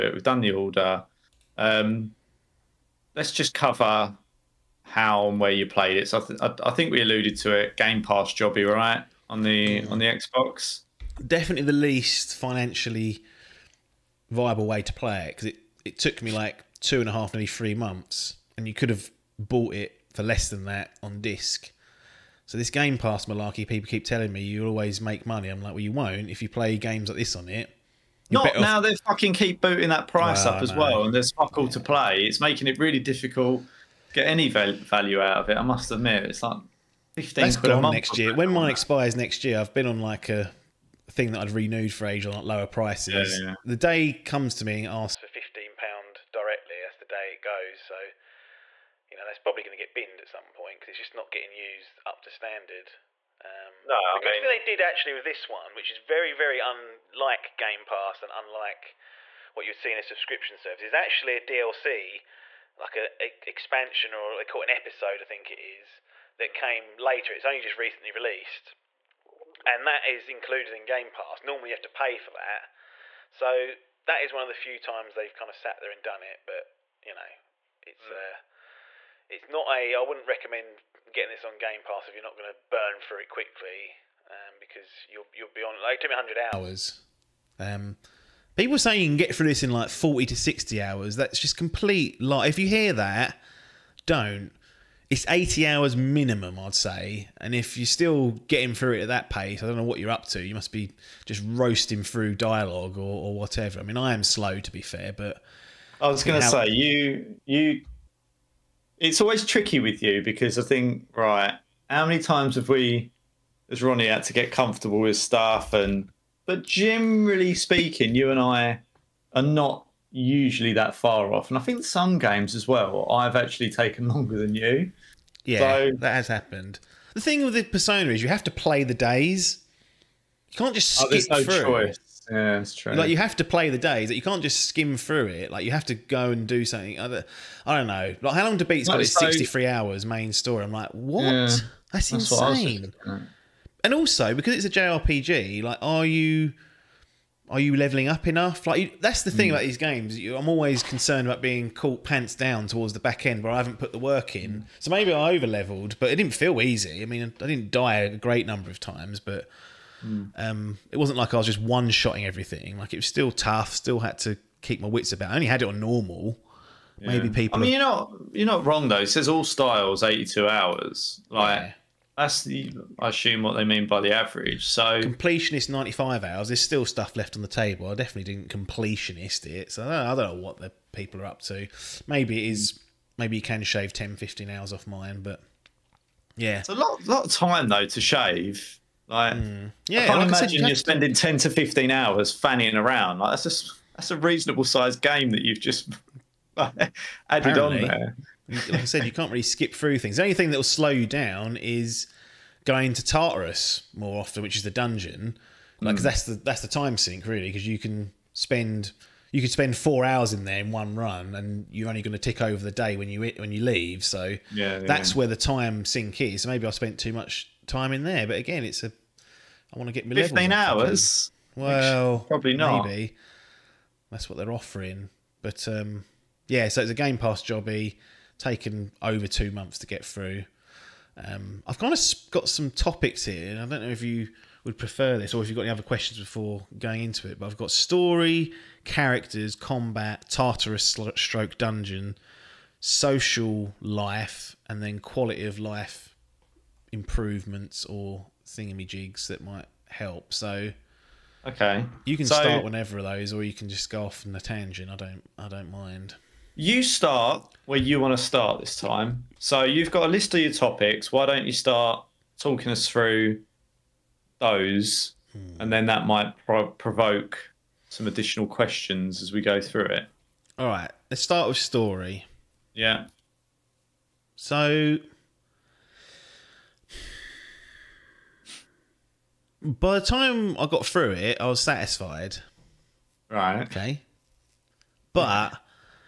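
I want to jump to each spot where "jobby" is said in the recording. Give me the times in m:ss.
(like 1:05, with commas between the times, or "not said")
0:08, 3:47.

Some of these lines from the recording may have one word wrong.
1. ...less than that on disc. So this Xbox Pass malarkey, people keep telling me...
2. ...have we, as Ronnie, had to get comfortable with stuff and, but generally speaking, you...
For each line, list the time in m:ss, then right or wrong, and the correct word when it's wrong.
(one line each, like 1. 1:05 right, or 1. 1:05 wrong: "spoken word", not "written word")
1. 0:20 wrong: "Game", not "Xbox"
2. 1:52 right.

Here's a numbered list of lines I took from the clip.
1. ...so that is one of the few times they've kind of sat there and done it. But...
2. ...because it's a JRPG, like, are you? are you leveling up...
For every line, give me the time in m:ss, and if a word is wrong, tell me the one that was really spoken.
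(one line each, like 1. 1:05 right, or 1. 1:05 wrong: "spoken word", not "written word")
1. 1:13 right
2. 2:24 right.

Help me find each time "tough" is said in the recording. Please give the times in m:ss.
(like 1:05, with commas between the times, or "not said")
2:43.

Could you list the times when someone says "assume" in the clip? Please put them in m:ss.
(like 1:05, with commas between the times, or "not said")
2:53.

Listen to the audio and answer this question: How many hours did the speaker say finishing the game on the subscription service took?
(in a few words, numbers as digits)
100.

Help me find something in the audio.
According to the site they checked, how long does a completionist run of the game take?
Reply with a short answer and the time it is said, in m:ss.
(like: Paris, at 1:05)
95 hours, at 2:55.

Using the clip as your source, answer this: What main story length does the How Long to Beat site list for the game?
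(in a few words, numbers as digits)
63 hours.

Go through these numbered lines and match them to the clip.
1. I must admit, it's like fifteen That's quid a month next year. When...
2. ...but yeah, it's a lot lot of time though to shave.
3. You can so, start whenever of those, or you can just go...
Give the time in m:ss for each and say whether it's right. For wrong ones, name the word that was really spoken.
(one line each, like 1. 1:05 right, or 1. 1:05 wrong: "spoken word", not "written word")
1. 0:35 right
2. 3:05 right
3. 4:12 right.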